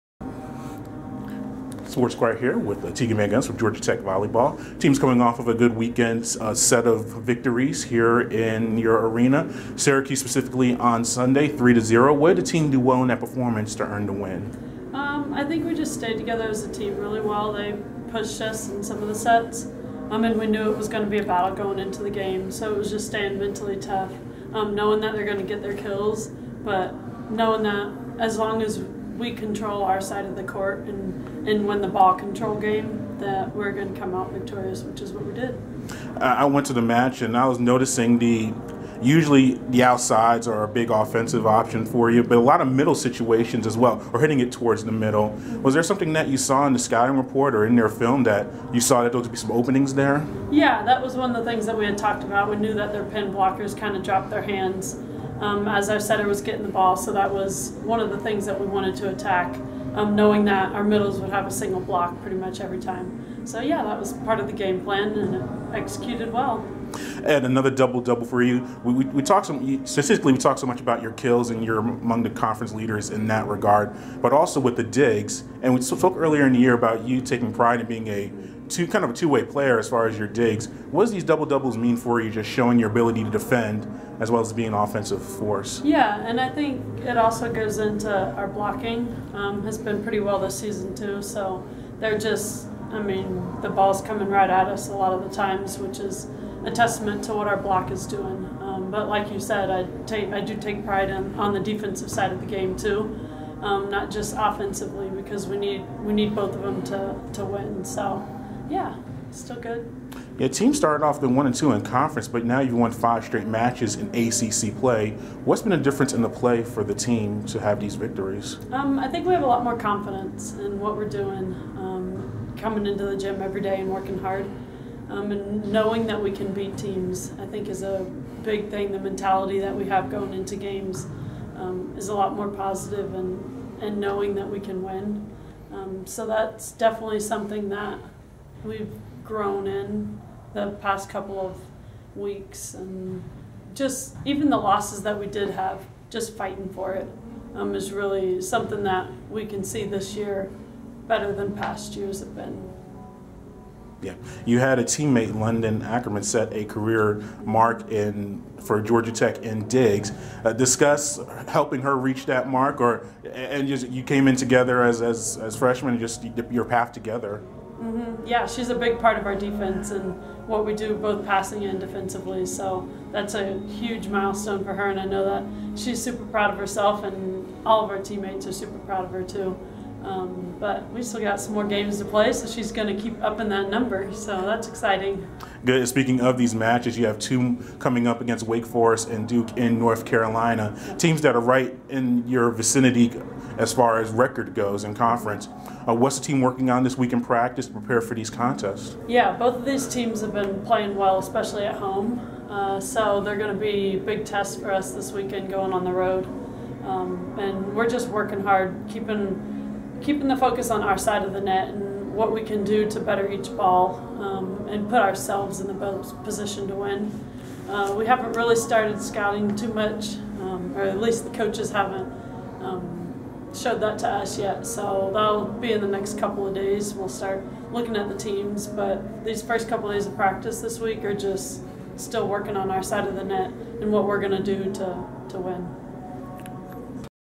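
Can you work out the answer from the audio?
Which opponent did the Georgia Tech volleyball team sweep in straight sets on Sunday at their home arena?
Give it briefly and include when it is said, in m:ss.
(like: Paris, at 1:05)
Syracuse, at 0:09.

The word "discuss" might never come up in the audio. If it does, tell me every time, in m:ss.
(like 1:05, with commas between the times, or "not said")
2:40.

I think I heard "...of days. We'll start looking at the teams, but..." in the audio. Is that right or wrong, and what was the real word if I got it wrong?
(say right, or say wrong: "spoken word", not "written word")
right.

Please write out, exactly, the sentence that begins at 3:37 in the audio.
Uh, we haven't really started scouting too much, um, or at least the coaches haven't.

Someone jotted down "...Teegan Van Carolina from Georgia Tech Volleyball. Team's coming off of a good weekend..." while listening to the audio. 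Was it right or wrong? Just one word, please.
wrong.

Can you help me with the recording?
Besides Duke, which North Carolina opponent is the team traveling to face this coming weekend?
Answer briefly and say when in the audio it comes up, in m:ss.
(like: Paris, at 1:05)
Wake Forest, at 3:08.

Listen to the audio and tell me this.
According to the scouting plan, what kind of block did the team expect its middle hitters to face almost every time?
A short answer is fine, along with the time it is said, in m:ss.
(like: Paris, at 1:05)
single block, at 1:01.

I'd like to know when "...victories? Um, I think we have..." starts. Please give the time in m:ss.
1:57.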